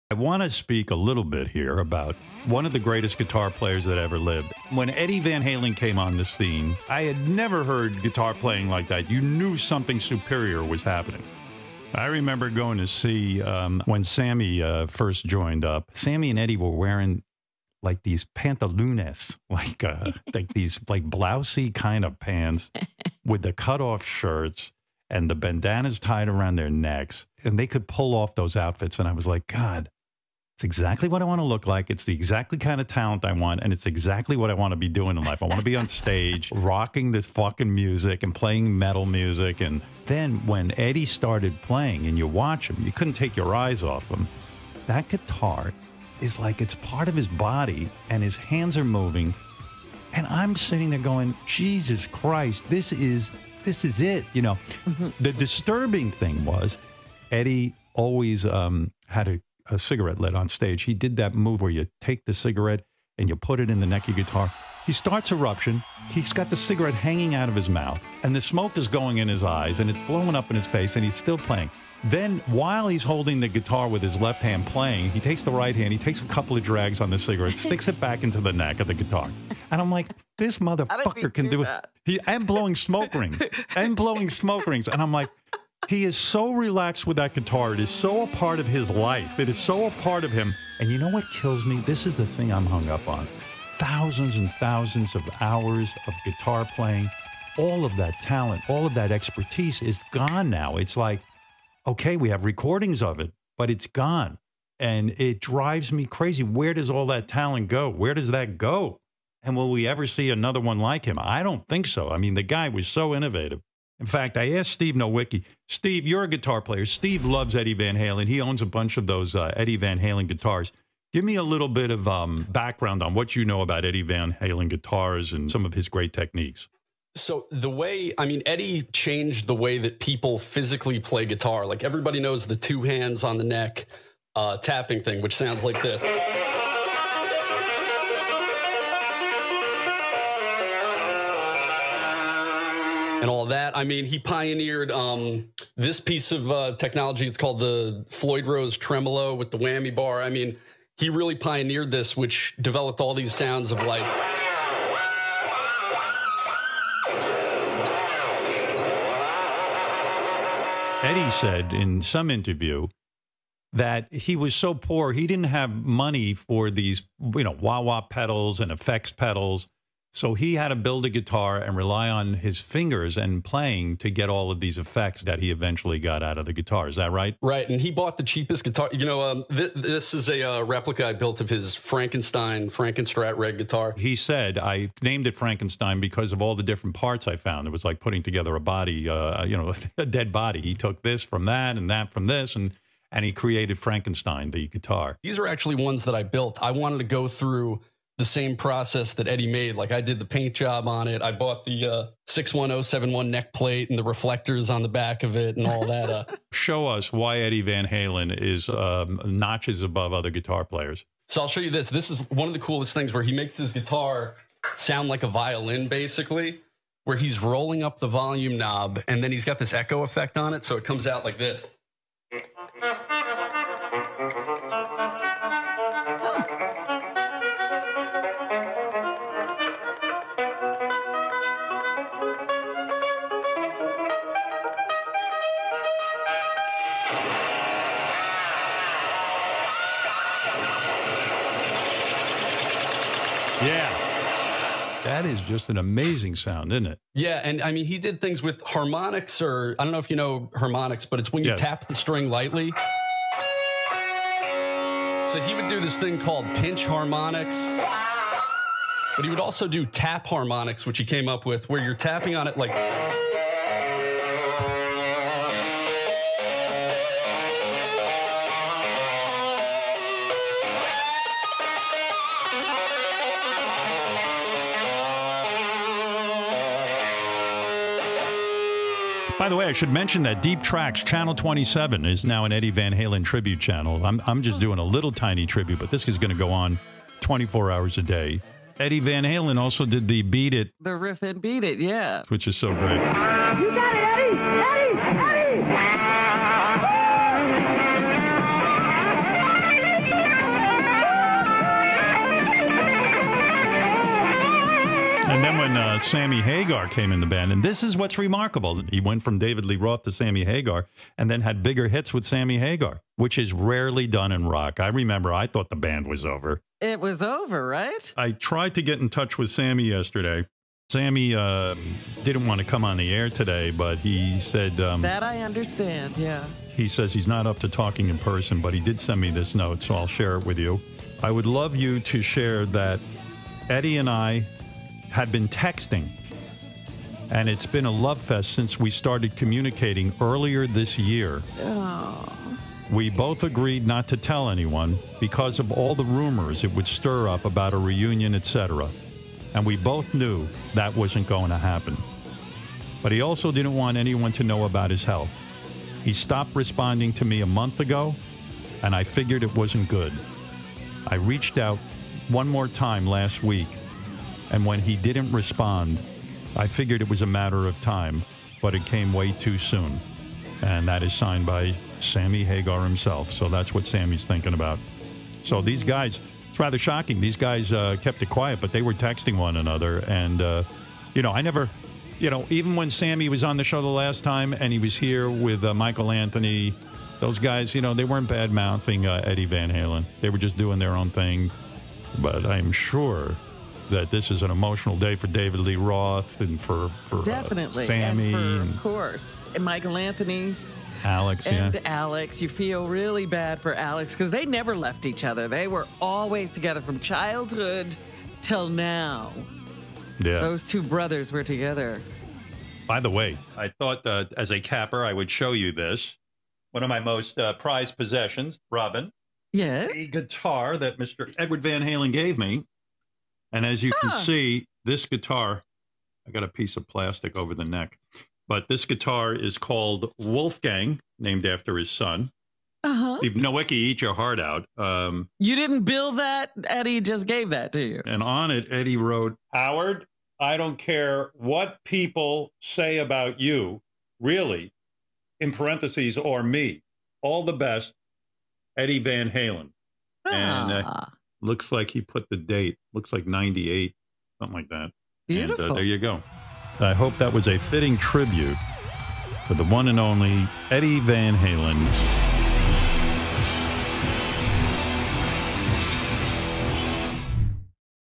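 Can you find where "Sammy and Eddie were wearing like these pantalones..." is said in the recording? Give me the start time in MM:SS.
00:15.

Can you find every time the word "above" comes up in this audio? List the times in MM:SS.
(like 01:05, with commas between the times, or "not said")
03:29.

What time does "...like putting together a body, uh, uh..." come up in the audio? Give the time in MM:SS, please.
03:07.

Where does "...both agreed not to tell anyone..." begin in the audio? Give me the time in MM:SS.
05:43.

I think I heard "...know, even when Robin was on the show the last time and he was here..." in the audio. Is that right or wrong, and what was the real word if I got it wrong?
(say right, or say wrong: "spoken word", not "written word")
wrong: "Sammy", not "Robin".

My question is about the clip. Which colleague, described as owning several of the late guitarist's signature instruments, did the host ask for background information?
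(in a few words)
Steve Nowicki.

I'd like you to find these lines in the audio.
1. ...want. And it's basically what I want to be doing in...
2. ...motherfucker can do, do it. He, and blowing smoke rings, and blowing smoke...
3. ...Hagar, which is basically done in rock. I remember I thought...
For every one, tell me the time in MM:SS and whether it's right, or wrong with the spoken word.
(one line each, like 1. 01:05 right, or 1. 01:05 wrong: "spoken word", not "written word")
1. 00:33 wrong: "exactly", not "basically"
2. 01:20 right
3. 05:12 wrong: "rarely", not "basically".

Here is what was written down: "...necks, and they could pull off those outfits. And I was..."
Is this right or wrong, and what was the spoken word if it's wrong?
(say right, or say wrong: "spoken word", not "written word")
right.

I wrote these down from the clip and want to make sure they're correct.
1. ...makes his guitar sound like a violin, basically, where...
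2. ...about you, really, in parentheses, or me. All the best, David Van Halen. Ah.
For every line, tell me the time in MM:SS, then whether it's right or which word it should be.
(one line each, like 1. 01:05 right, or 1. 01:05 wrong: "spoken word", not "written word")
1. 03:33 right
2. 07:22 wrong: "Eddie", not "David".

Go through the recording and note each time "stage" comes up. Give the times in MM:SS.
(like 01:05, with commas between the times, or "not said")
00:35, 01:00.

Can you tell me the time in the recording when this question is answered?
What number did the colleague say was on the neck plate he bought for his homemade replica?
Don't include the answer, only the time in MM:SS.
03:22.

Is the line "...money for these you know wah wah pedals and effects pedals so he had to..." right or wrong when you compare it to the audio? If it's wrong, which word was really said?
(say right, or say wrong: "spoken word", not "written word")
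right.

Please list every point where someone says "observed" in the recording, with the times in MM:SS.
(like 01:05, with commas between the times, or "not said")
not said.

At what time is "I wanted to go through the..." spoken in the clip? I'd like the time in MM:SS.
03:16.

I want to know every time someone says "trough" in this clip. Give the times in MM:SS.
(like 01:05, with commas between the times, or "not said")
not said.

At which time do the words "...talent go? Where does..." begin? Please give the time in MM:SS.
01:47.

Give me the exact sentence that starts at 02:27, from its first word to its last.
It's called the Floyd Rose tremolo with the whammy bar.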